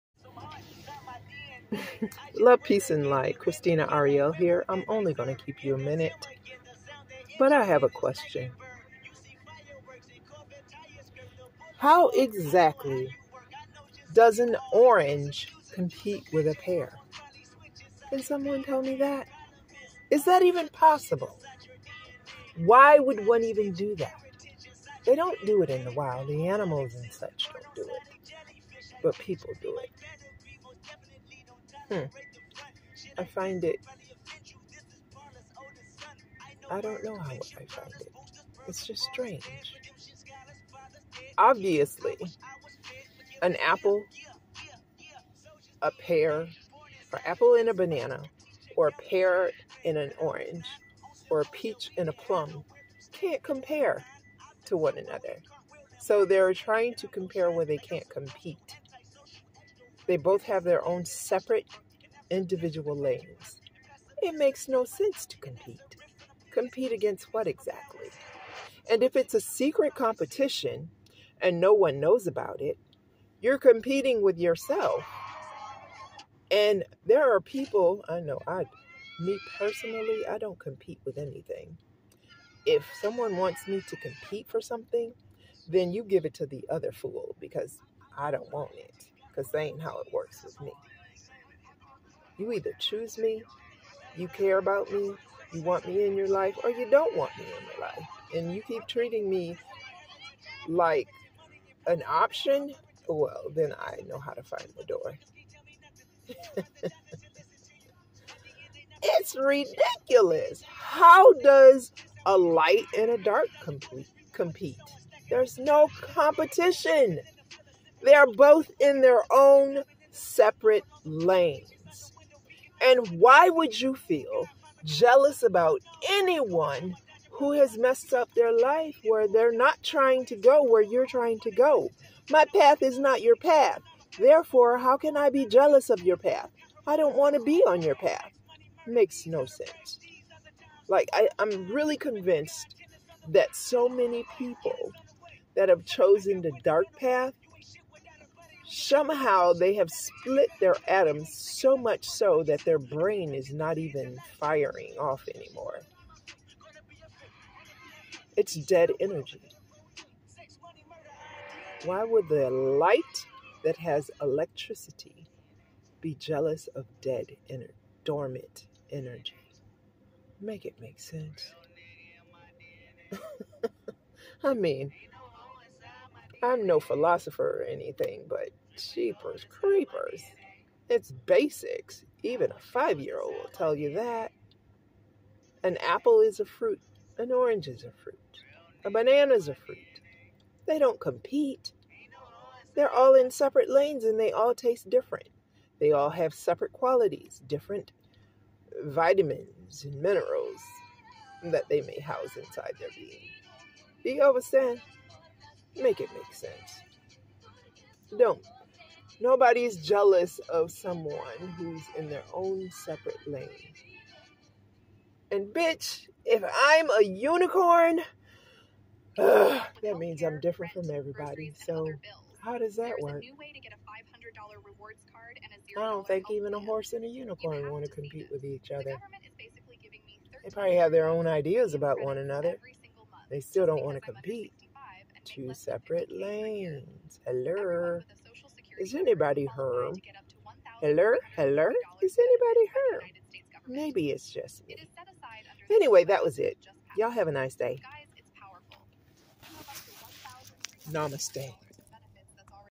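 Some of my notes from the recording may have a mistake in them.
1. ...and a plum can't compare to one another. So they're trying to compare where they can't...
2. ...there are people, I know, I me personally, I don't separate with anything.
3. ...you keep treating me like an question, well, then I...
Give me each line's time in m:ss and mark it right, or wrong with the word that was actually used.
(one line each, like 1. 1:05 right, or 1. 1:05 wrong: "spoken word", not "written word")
1. 0:51 right
2. 1:17 wrong: "compete", not "separate"
3. 1:38 wrong: "option", not "question".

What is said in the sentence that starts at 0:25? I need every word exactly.
They don't do it in the wild.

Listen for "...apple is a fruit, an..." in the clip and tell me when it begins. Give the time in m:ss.
3:05.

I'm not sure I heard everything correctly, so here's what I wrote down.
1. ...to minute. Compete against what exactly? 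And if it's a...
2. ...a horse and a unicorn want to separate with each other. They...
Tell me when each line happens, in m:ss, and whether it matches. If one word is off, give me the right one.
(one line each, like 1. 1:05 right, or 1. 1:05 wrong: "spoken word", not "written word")
1. 1:05 wrong: "compete", not "minute"
2. 3:46 wrong: "compete", not "separate".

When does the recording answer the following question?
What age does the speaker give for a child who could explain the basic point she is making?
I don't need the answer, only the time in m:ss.
3:02.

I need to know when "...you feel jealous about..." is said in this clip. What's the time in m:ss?
2:03.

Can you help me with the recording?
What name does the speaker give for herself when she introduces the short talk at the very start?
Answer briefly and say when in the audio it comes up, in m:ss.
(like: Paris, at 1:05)
Christina Arielle, at 0:03.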